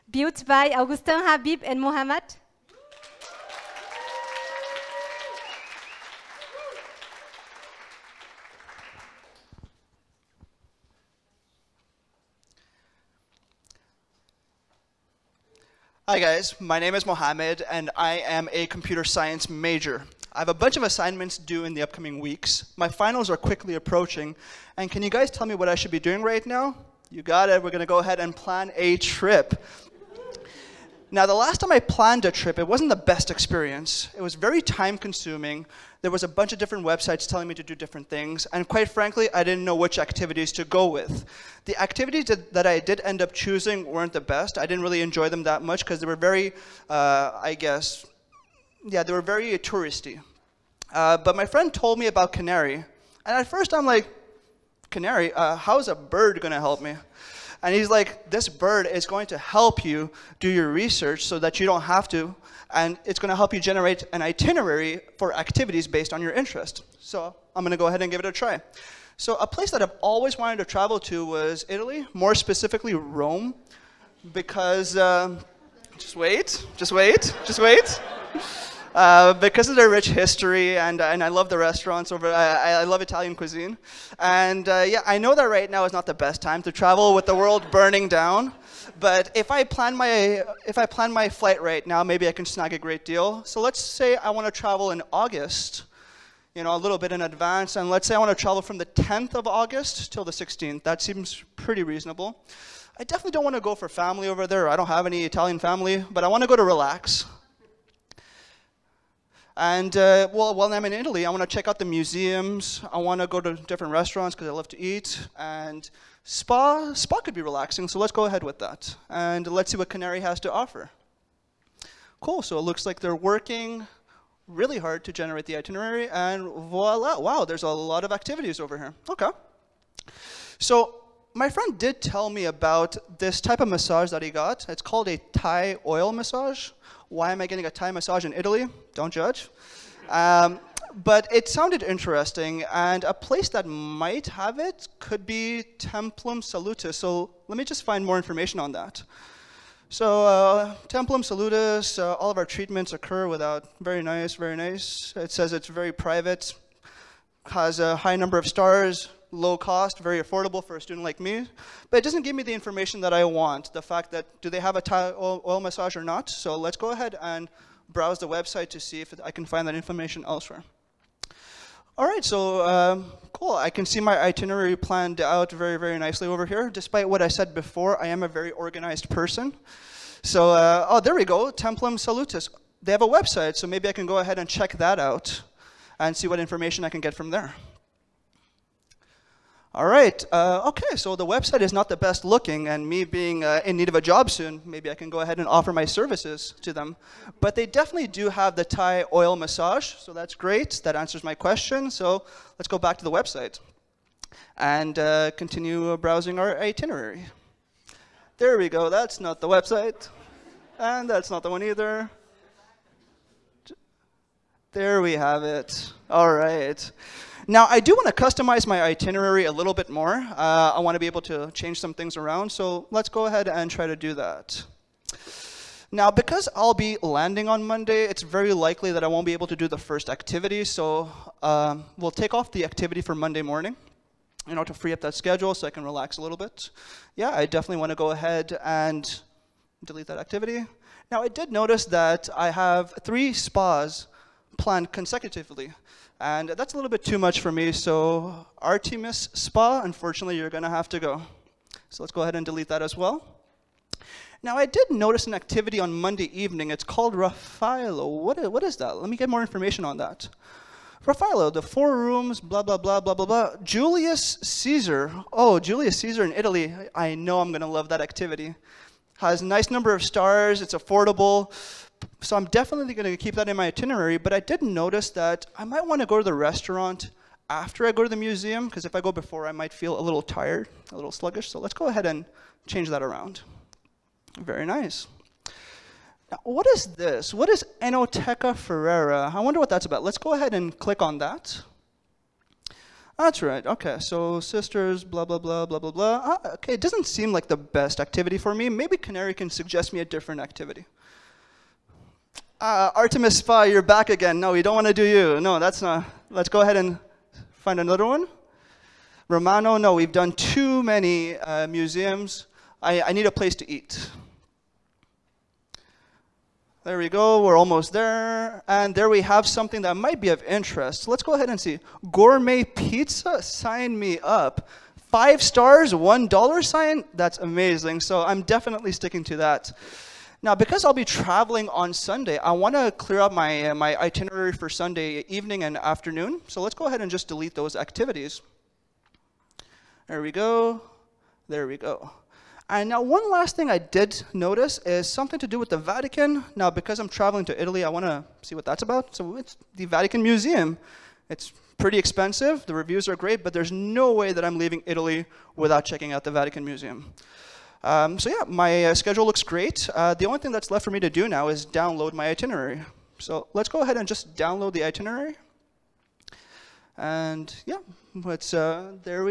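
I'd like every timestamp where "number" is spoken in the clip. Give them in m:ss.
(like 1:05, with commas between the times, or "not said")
2:38, 4:29.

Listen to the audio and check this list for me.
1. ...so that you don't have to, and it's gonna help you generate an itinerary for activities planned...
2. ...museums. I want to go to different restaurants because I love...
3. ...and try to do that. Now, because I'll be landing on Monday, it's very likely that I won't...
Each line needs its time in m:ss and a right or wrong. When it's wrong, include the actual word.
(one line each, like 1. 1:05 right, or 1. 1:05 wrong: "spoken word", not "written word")
1. 1:01 wrong: "based", not "planned"
2. 1:51 right
3. 3:43 right.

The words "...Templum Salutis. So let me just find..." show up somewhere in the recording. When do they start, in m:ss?
2:25.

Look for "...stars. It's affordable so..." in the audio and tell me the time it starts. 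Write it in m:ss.
4:30.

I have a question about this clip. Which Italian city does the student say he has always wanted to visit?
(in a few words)
Rome.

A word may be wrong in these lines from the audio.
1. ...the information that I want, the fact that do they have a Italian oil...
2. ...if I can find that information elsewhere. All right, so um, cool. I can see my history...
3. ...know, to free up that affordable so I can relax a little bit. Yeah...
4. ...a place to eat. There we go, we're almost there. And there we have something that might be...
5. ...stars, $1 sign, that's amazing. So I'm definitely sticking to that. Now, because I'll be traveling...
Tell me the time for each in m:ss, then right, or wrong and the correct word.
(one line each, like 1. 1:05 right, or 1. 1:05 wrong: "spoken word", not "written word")
1. 2:42 wrong: "Thai", not "Italian"
2. 2:49 wrong: "itinerary", not "history"
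3. 3:54 wrong: "schedule", not "affordable"
4. 5:13 right
5. 5:25 right.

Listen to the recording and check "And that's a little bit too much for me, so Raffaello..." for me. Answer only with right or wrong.
wrong.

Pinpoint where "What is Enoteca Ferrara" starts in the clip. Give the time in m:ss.
4:47.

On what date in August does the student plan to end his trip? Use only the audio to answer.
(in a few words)
16th.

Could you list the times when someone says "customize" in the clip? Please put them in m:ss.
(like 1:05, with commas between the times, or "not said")
3:38.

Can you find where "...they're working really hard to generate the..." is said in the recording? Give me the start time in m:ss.
2:02.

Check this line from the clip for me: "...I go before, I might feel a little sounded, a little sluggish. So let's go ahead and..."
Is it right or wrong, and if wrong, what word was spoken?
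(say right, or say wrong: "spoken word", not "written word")
wrong: "tired", not "sounded".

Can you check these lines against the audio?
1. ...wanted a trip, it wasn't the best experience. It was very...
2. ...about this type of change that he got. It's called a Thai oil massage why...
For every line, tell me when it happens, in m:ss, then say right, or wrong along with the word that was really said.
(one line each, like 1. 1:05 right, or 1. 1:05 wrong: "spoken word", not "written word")
1. 0:31 wrong: "planned", not "wanted"
2. 2:12 wrong: "massage", not "change".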